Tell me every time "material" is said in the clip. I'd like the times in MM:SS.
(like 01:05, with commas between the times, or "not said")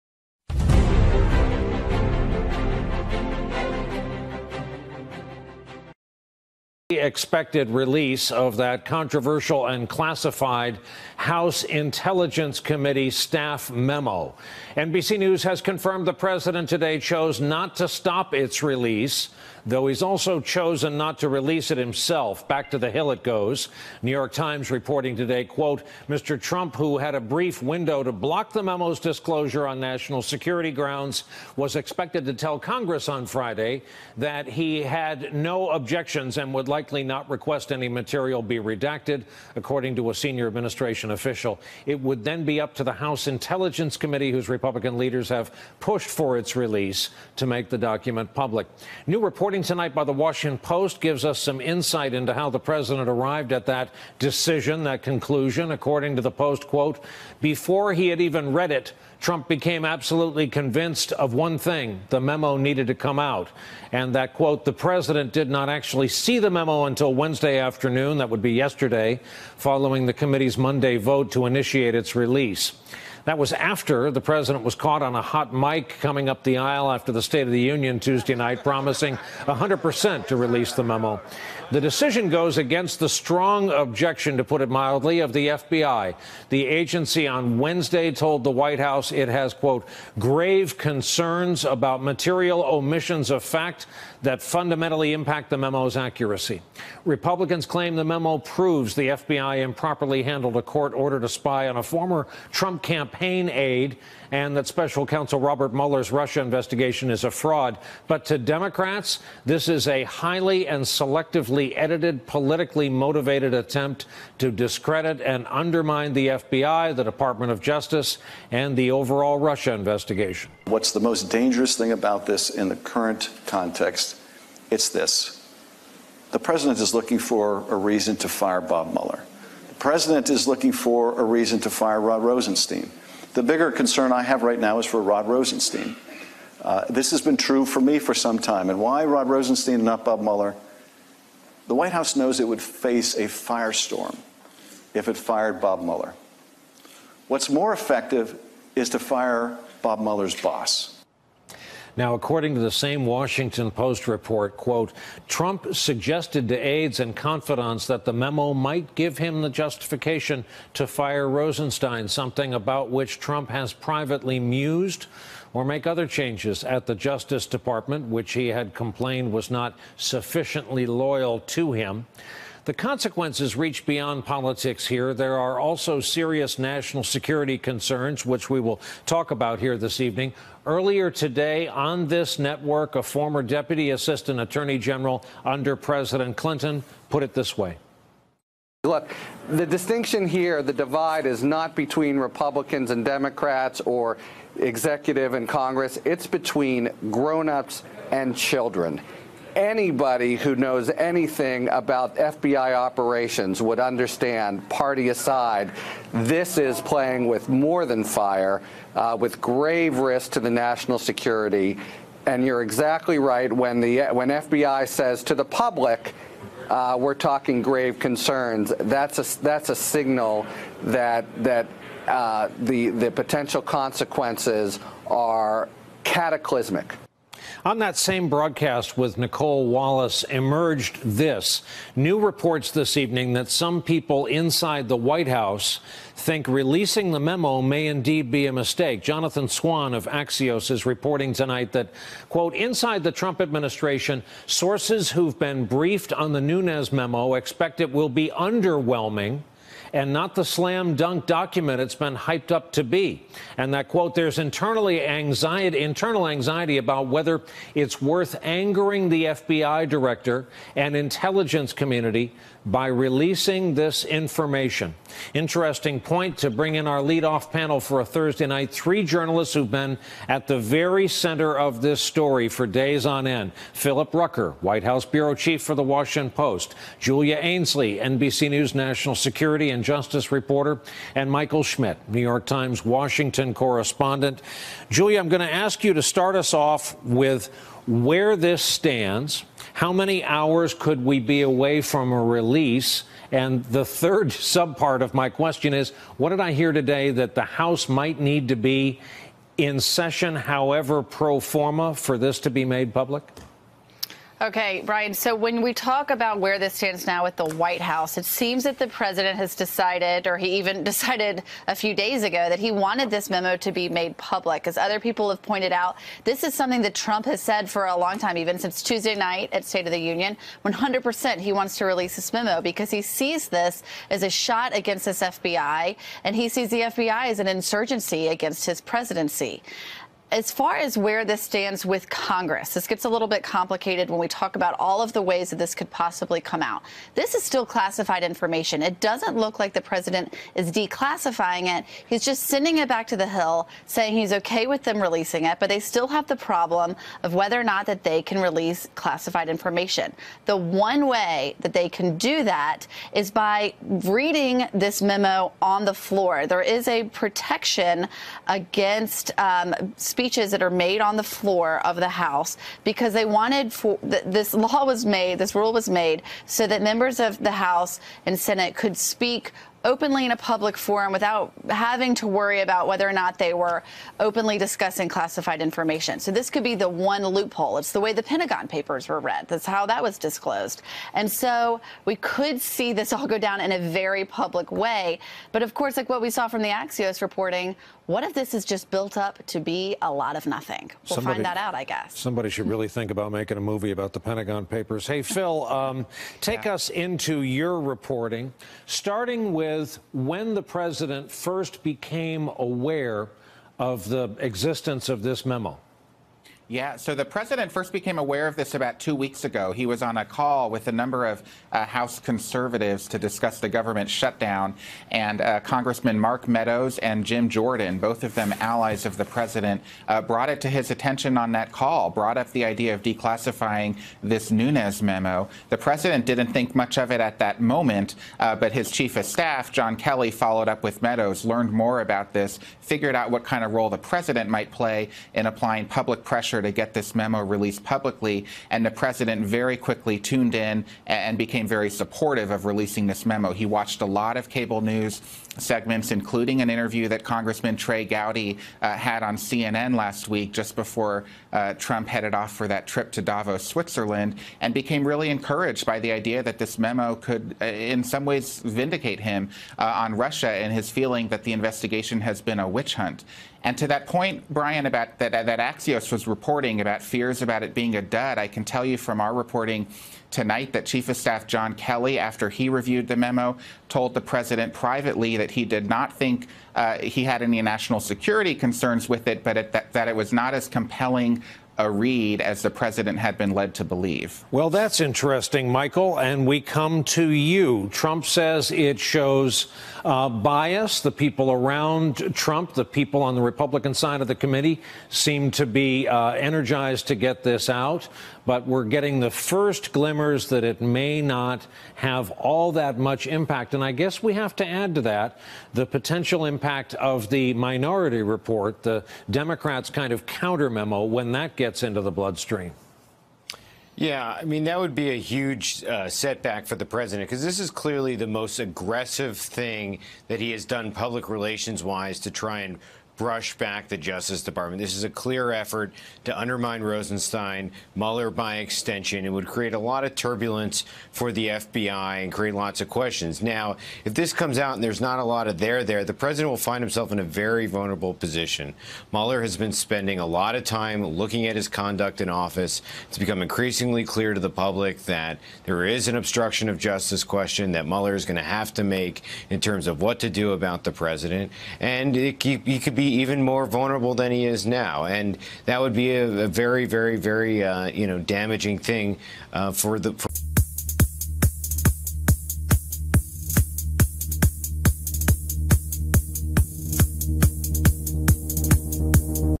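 00:37, 01:32.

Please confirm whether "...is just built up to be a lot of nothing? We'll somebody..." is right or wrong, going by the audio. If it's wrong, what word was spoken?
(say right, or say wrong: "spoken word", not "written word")
right.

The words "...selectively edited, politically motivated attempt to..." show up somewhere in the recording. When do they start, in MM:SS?
01:50.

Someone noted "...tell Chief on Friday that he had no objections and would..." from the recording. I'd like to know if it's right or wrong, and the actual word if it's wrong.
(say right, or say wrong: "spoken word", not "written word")
wrong: "Congress", not "Chief".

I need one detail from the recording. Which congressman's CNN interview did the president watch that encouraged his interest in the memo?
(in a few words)
Trey Gowdy.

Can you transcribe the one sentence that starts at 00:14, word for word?
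NBC News has confirmed the president today chose not to stop its release, though he's also chosen not to release it himself.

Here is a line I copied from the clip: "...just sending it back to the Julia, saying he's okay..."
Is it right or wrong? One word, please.
wrong.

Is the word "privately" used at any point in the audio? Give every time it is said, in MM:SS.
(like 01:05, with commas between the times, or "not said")
02:43, 07:54.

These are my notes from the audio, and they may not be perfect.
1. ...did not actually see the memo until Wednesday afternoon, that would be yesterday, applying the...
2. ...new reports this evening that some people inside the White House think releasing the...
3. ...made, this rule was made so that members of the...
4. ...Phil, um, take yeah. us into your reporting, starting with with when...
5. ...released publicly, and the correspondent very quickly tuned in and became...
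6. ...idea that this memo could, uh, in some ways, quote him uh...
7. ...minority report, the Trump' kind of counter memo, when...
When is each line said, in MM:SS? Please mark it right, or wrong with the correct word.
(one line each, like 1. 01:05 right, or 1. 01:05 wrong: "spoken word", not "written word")
1. 01:05 wrong: "following", not "applying"
2. 03:51 right
3. 06:05 right
4. 06:35 right
5. 07:17 wrong: "president", not "correspondent"
6. 07:36 wrong: "vindicate", not "quote"
7. 08:27 wrong: "Democrats", not "Trump".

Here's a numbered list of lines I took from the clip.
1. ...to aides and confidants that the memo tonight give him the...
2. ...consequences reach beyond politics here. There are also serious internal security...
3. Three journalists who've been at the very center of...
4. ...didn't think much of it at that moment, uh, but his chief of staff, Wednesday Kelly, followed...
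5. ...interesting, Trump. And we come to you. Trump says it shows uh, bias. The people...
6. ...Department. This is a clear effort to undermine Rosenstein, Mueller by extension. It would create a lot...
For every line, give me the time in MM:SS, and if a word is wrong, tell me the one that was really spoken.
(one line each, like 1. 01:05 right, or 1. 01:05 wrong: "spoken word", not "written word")
1. 02:36 wrong: "might", not "tonight"
2. 02:52 wrong: "national", not "internal"
3. 04:28 right
4. 07:06 wrong: "John", not "Wednesday"
5. 08:05 wrong: "Michael", not "Trump"
6. 08:44 right.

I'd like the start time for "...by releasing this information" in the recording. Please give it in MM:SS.
04:22.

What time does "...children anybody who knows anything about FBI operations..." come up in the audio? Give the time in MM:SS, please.
03:18.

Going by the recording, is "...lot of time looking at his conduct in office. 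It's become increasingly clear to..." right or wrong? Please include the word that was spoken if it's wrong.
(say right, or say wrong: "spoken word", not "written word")
right.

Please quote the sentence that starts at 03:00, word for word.
Earlier today on this network, a former deputy assistant attorney general under President Clinton put it this way.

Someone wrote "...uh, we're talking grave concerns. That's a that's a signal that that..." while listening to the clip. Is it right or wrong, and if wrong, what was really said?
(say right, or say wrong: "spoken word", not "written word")
right.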